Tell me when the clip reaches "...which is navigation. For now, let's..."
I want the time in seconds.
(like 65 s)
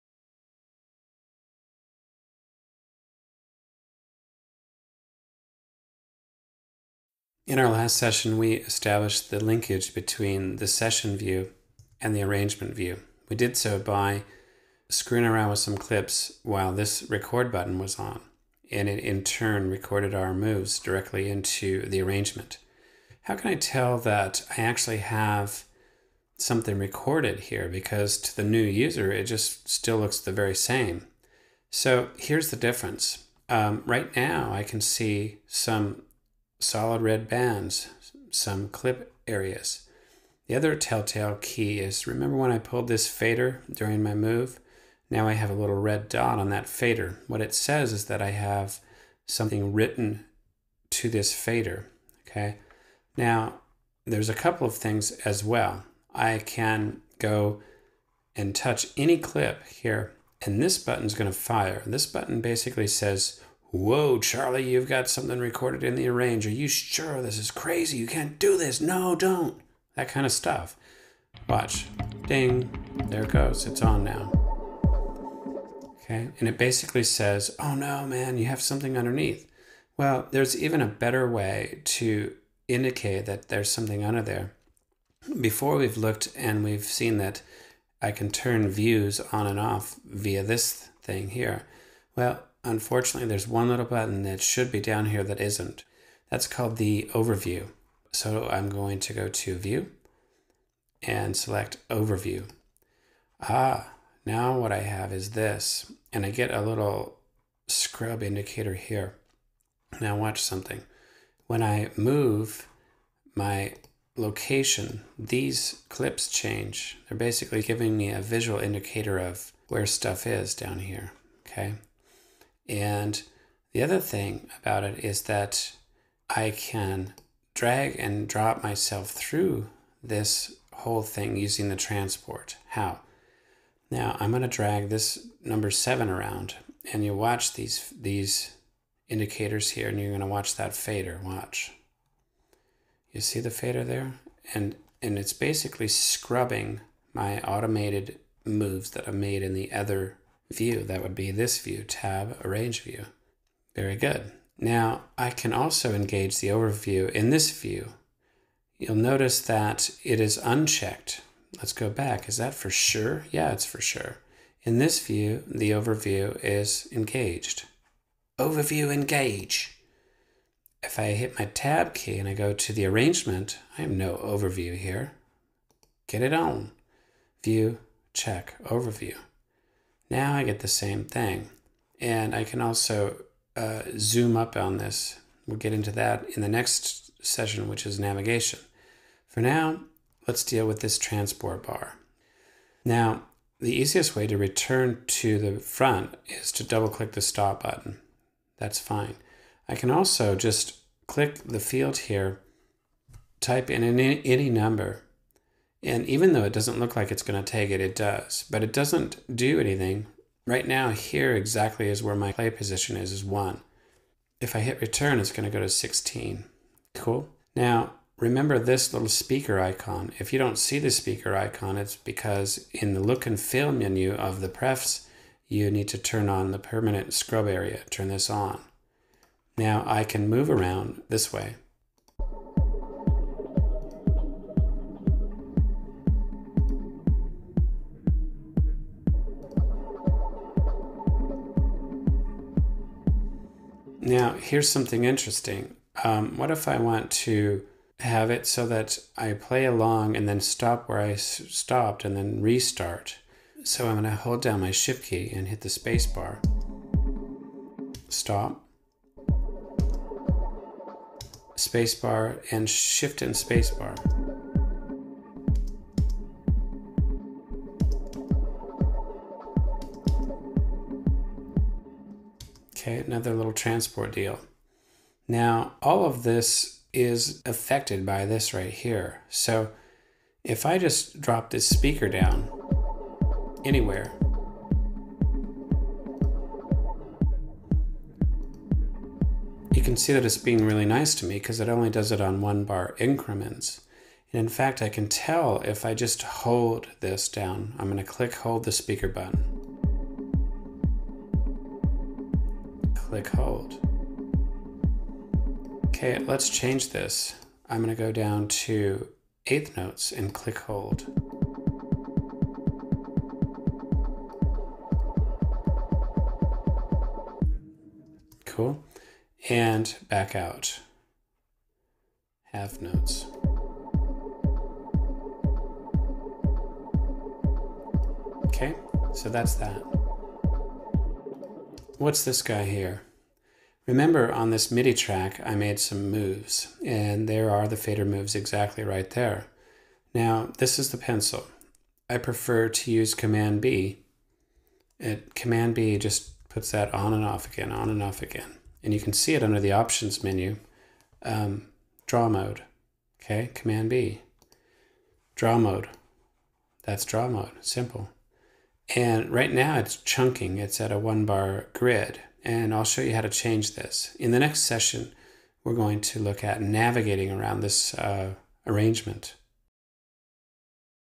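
187 s.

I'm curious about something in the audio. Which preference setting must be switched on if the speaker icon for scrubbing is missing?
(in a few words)
permanent scrub area.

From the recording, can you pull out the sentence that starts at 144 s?
And, and it's basically scrubbing my automated moves that I made in the other view.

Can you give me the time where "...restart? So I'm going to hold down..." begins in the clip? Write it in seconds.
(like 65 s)
252 s.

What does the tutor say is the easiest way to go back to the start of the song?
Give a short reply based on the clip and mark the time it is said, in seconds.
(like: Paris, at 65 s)
double click the stop button, at 196 s.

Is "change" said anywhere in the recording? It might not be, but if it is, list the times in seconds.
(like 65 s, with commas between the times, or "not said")
116 s, 306 s, 363 s.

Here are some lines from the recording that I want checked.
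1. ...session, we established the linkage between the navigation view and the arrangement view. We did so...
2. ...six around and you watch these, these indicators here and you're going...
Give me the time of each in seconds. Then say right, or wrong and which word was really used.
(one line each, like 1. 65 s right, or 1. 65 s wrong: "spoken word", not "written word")
1. 7 s wrong: "session", not "navigation"
2. 135 s wrong: "seven", not "six".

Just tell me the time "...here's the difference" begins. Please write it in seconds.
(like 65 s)
32 s.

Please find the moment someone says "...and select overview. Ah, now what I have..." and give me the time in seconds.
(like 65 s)
101 s.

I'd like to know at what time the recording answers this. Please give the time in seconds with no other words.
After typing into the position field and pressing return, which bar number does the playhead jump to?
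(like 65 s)
215 s.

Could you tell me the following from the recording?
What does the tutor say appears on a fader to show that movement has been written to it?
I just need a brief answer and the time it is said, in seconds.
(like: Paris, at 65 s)
little red dot, at 45 s.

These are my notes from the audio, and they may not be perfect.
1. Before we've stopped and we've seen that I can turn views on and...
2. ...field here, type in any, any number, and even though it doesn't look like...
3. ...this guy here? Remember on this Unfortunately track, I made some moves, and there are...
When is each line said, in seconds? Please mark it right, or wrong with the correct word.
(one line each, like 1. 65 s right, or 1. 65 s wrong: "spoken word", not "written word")
1. 85 s wrong: "looked", not "stopped"
2. 201 s right
3. 332 s wrong: "MIDI", not "Unfortunately".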